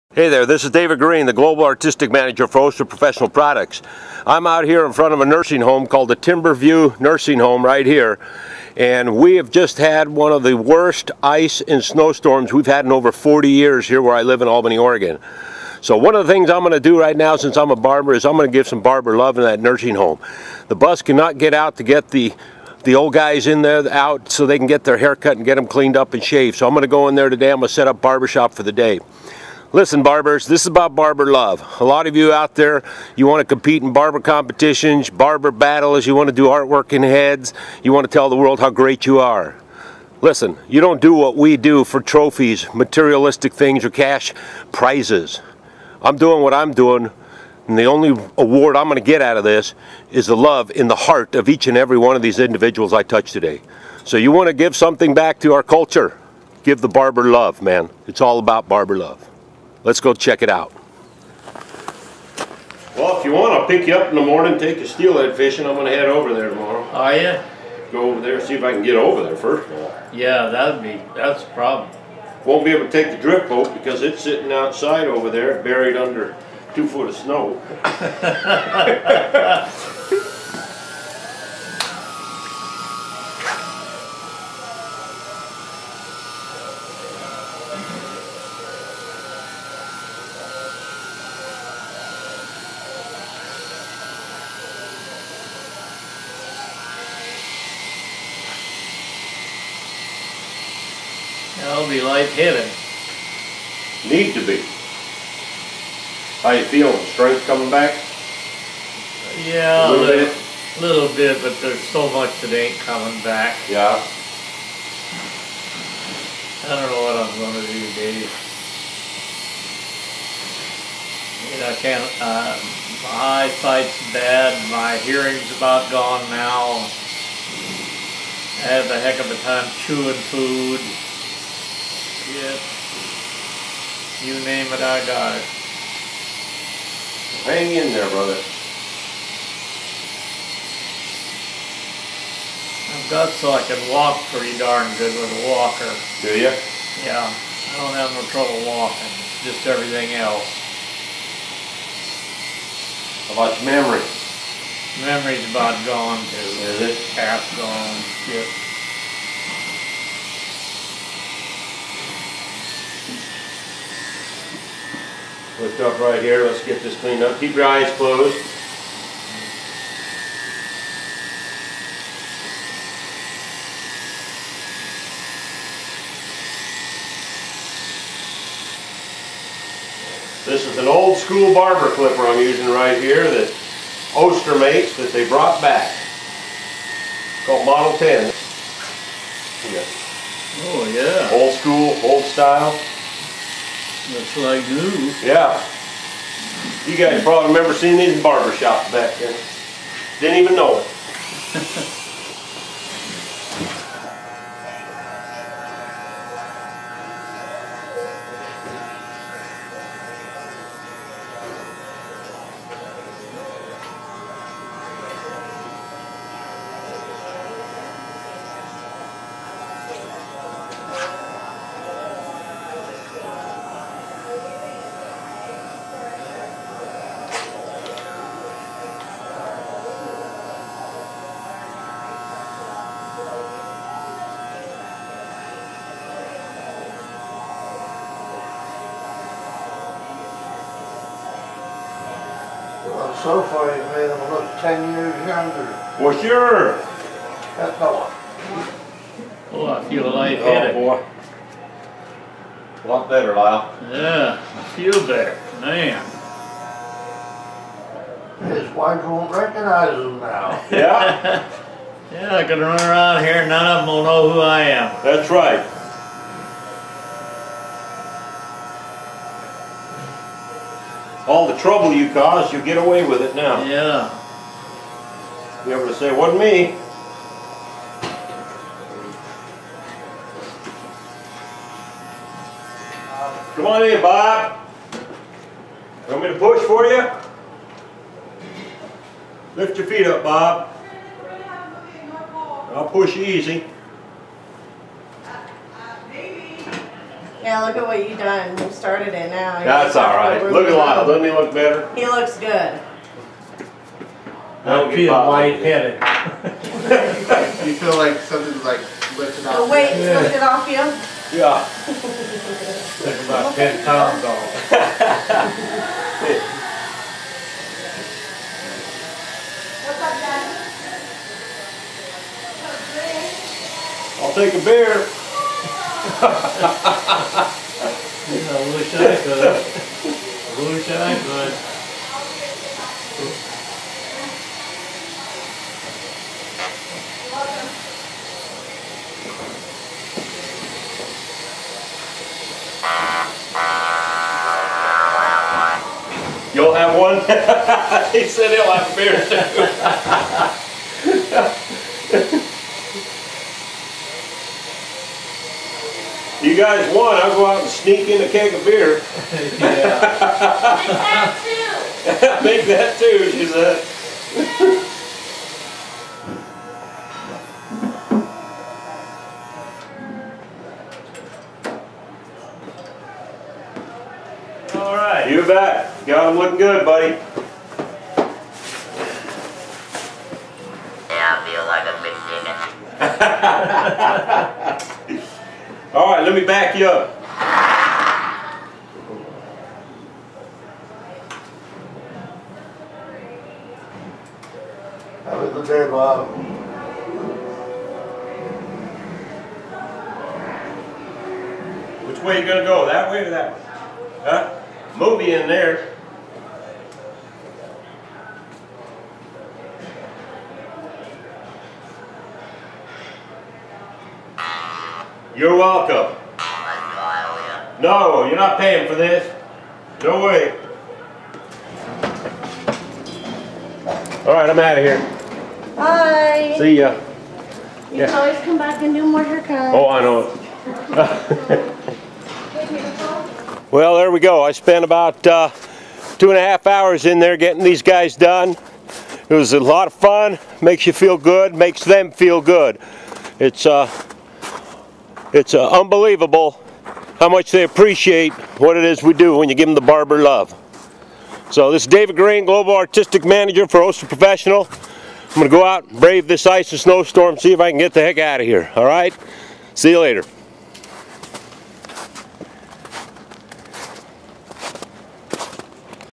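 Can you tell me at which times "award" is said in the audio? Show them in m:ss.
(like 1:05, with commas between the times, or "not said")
0:48.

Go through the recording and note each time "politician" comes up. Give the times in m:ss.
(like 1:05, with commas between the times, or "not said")
not said.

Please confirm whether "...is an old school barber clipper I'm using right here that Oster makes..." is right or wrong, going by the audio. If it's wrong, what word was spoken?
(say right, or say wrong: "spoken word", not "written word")
right.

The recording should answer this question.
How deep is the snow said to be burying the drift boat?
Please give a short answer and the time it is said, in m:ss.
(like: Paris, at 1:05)
2 feet, at 1:16.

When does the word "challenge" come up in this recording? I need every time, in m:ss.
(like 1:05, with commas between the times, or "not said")
not said.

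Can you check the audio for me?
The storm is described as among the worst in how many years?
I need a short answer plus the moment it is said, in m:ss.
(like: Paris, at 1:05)
40, at 0:12.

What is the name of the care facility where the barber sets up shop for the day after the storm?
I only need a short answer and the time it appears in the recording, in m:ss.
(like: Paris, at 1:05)
Timberview Nursing Home, at 0:06.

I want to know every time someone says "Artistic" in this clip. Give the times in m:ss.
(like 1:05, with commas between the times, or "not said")
0:01, 7:32.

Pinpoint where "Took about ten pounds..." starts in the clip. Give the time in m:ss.
5:13.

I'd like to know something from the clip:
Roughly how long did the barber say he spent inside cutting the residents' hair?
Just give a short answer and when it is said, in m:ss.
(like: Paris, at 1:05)
2.5 hours, at 7:16.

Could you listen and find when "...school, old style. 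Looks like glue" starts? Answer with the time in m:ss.
3:11.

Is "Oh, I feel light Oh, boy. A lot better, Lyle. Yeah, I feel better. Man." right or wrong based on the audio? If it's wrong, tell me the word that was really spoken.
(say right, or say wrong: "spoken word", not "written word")
right.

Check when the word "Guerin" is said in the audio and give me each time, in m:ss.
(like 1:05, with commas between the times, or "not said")
0:00, 7:32.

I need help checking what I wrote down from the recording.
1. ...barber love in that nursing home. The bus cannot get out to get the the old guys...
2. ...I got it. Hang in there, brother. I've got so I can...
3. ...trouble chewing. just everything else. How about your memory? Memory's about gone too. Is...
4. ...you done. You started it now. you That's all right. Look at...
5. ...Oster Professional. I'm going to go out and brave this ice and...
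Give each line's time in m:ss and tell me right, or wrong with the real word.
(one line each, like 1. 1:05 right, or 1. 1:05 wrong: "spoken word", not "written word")
1. 0:18 right
2. 2:14 right
3. 2:28 wrong: "walking", not "chewing"
4. 4:58 right
5. 7:33 right.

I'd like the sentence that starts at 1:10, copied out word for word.
Yeah, that'd be, that's a problem.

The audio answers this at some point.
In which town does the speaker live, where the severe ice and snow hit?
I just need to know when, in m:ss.
0:14.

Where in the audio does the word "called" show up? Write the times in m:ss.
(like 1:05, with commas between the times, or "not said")
0:05, 3:07.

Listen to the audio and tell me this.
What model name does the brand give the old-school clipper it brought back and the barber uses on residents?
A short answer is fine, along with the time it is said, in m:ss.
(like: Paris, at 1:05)
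Model 10, at 3:07.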